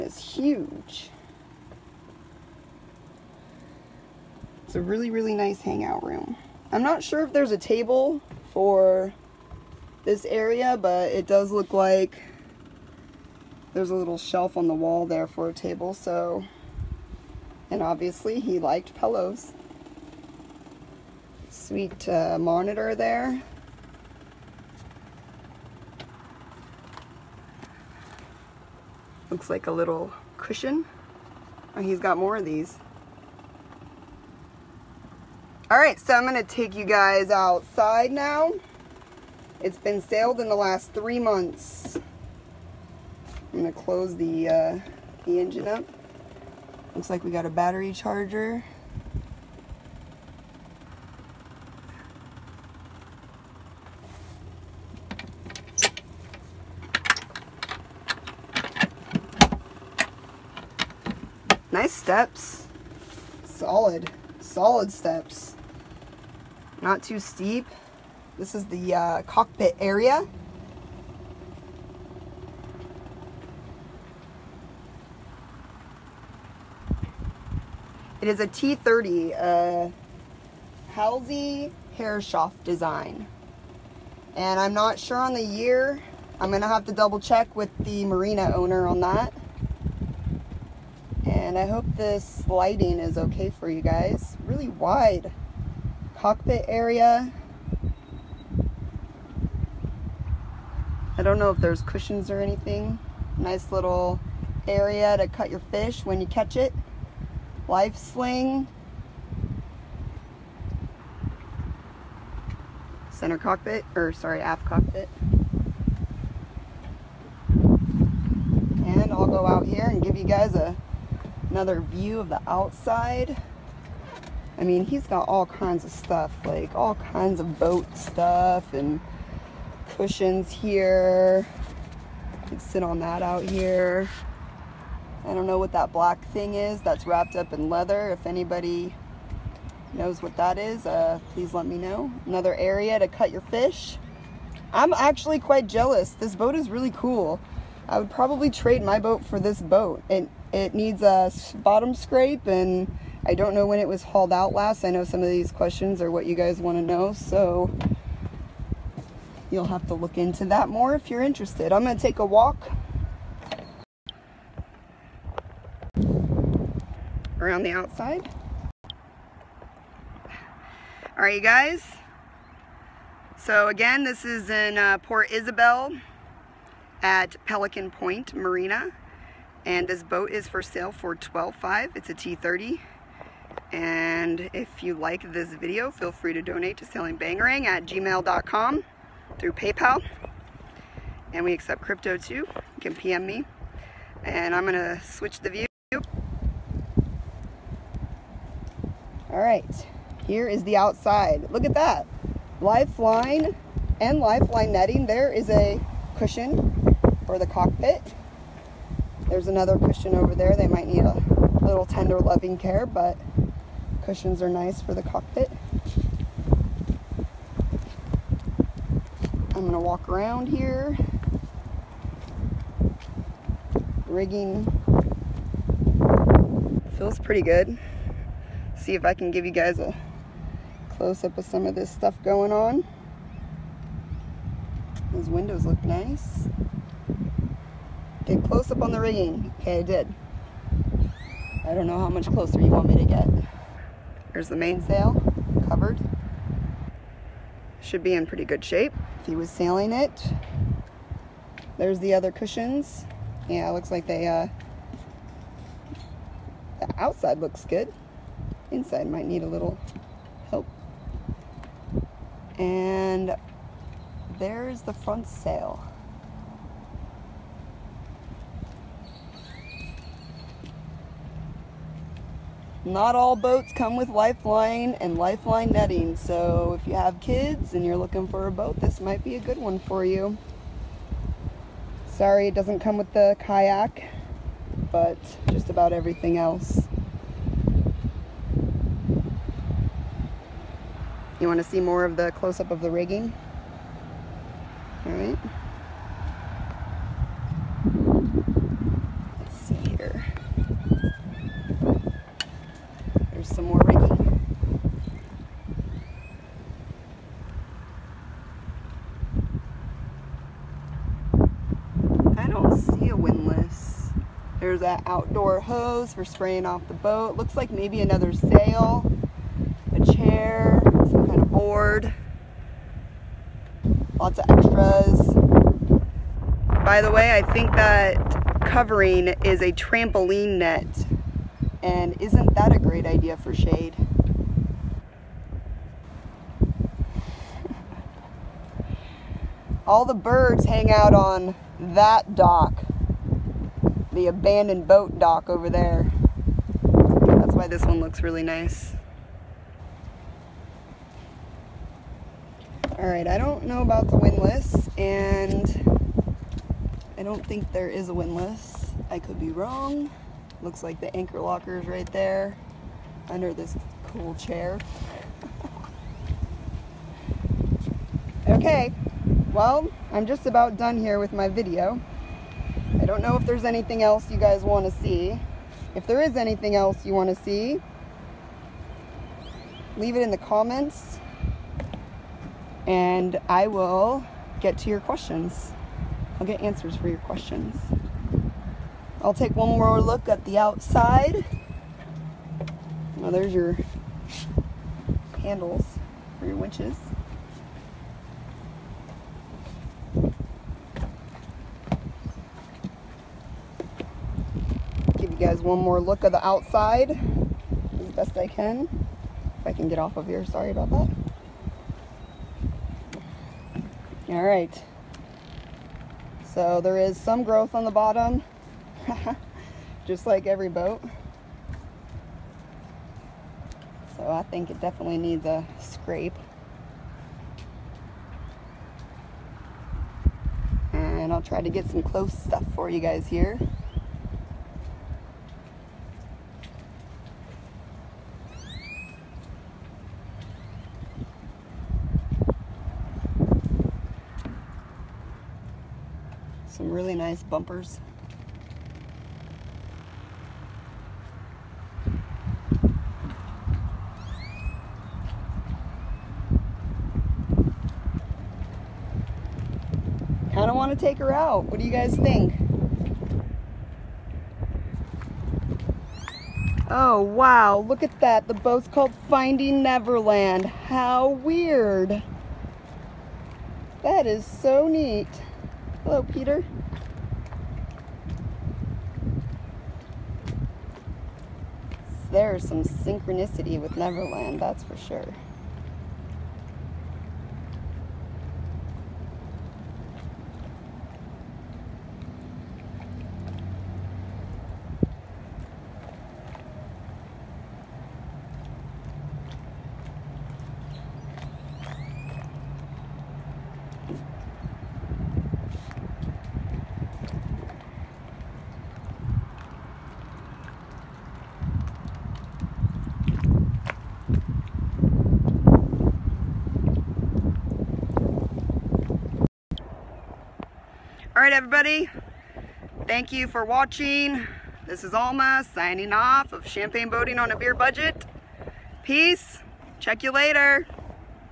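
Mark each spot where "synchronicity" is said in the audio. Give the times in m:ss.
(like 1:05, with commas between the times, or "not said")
8:02.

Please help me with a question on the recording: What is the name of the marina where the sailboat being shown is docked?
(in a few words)
Pelican Point Marina.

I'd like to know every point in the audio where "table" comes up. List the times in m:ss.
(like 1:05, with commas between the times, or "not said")
0:07, 0:15.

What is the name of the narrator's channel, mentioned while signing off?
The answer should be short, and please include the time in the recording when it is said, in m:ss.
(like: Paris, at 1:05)
Champagne Boating on a Beer Budget, at 8:46.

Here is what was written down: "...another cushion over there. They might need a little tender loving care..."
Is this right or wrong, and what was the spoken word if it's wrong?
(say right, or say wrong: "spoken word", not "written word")
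right.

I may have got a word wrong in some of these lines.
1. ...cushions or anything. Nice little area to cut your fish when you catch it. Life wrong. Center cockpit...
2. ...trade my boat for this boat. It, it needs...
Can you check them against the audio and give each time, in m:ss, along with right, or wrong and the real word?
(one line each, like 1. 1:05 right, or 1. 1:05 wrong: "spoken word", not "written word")
1. 1:41 wrong: "sling", not "wrong"
2. 2:28 right.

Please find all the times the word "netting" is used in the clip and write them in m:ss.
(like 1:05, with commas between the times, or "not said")
3:24, 4:35.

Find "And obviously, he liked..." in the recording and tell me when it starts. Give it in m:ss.
0:17.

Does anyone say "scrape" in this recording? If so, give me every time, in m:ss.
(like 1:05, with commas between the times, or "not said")
2:31, 7:05.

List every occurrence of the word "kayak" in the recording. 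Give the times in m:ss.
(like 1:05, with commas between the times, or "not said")
4:43.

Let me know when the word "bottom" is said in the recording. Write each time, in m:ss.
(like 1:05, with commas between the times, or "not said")
2:31, 6:57.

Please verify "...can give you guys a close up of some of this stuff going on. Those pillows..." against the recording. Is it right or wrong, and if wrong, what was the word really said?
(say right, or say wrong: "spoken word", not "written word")
wrong: "windows", not "pillows".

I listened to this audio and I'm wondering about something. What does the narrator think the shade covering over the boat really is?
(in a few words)
trampoline net.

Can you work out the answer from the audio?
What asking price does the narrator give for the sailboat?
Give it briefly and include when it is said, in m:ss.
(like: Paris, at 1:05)
12.5, at 3:01.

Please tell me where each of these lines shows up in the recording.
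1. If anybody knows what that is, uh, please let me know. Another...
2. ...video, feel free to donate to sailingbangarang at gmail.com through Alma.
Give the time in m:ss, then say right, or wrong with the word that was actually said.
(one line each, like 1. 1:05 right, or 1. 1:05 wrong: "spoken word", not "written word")
1. 2:18 right
2. 3:05 wrong: "PayPal", not "Alma".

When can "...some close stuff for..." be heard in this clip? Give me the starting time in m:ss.
7:11.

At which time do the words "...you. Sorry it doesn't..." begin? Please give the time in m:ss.
4:40.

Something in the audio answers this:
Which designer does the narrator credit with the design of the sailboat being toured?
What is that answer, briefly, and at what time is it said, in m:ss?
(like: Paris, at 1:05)
Halsey Herreshoff, at 1:20.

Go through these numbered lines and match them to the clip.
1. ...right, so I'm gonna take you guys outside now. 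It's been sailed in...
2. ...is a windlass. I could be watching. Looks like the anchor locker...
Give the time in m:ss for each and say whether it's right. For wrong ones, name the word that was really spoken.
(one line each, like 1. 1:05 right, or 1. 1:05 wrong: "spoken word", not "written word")
1. 0:35 right
2. 5:57 wrong: "wrong", not "watching".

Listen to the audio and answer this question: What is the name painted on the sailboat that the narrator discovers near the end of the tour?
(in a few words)
Finding Neverland.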